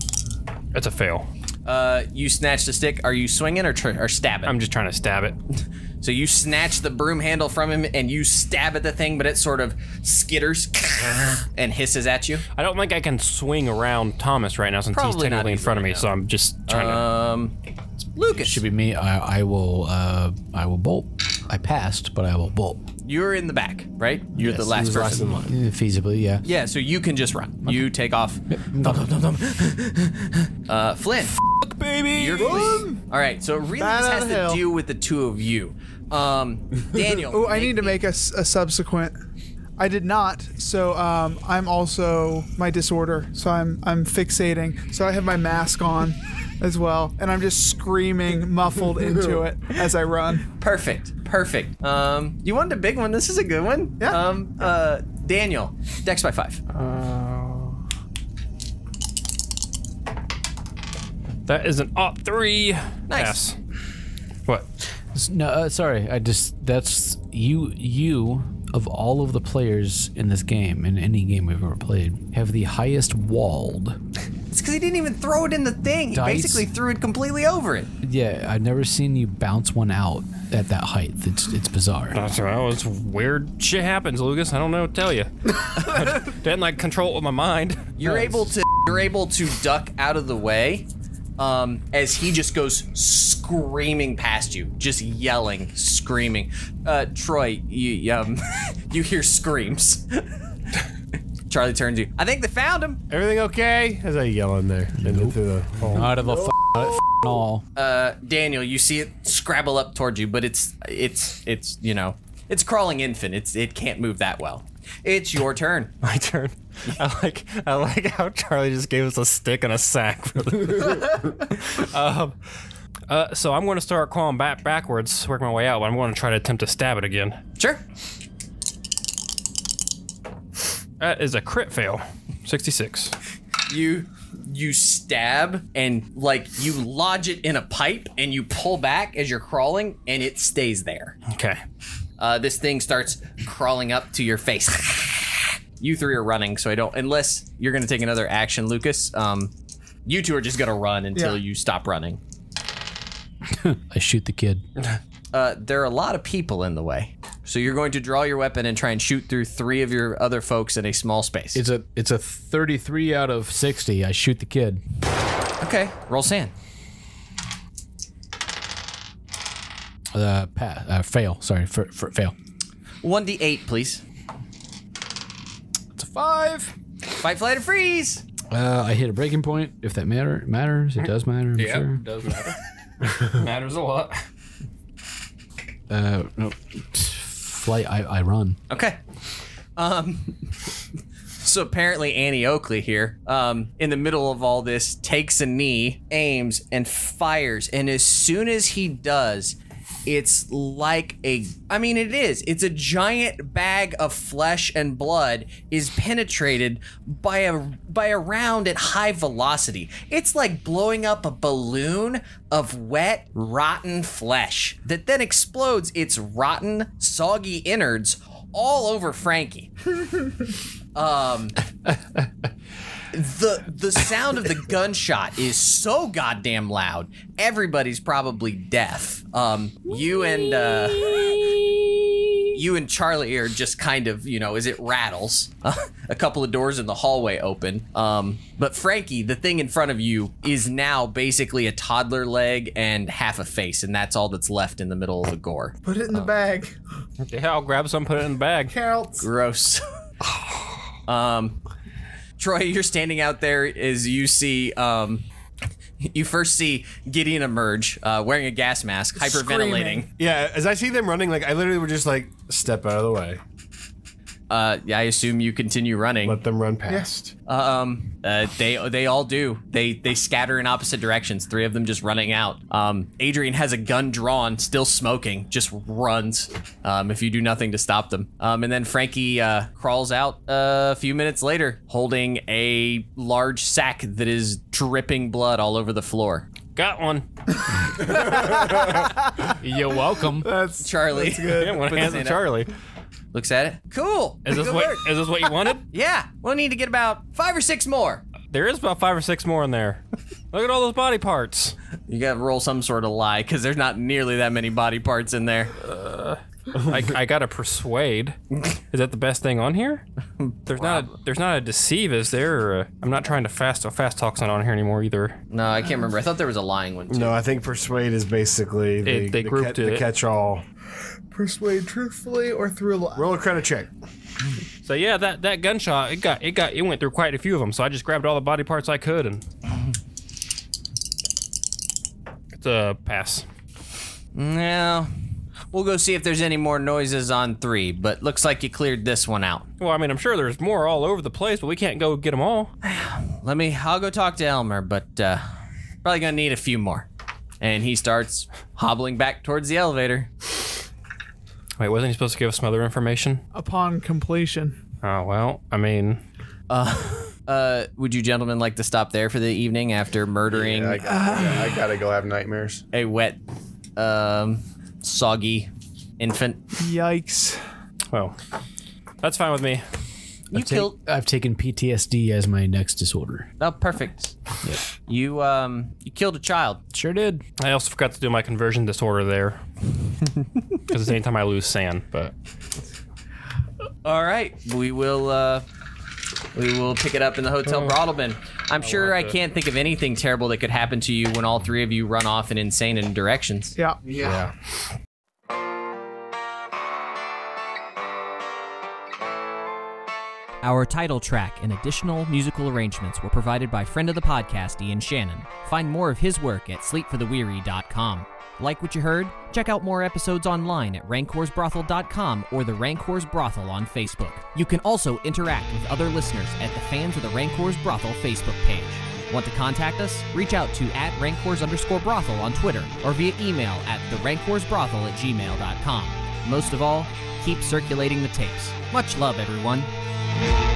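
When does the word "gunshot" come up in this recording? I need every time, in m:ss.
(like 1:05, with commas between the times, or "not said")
3:44, 5:25.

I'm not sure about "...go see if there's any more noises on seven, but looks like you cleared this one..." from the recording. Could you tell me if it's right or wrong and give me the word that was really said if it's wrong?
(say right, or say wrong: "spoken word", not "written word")
wrong: "three", not "seven".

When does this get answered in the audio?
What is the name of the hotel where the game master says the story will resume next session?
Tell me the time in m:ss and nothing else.
6:27.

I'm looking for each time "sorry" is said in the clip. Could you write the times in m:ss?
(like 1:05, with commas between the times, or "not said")
1:05, 2:51.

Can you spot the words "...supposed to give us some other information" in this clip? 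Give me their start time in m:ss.
5:52.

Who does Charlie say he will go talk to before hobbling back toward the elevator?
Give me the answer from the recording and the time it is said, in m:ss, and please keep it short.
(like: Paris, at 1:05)
Elmer, at 5:44.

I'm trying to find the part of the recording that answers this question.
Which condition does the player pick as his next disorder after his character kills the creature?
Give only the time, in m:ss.
6:11.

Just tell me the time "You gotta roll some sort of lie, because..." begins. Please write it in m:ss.
5:02.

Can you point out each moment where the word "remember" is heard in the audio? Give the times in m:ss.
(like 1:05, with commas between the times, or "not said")
5:15.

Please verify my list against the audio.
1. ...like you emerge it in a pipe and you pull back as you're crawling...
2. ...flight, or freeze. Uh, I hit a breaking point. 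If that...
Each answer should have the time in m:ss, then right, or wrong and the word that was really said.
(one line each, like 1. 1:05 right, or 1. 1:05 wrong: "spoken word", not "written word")
1. 2:16 wrong: "lodge", not "emerge"
2. 2:57 right.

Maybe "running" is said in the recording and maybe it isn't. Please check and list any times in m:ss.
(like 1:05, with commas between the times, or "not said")
2:26, 2:31, 4:21, 4:25, 4:32.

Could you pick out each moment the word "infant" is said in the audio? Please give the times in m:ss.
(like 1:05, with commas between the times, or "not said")
1:52, 6:06.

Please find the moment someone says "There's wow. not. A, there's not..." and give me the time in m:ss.
5:10.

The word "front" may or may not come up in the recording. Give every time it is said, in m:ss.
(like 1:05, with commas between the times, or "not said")
0:15, 3:59.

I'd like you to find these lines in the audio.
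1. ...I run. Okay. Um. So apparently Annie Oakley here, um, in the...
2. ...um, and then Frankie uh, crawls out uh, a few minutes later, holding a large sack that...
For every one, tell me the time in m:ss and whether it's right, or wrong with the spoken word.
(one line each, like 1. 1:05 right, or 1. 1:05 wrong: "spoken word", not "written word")
1. 3:08 right
2. 4:38 right.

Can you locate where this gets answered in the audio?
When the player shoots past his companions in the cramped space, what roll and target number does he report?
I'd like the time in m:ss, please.
2:42.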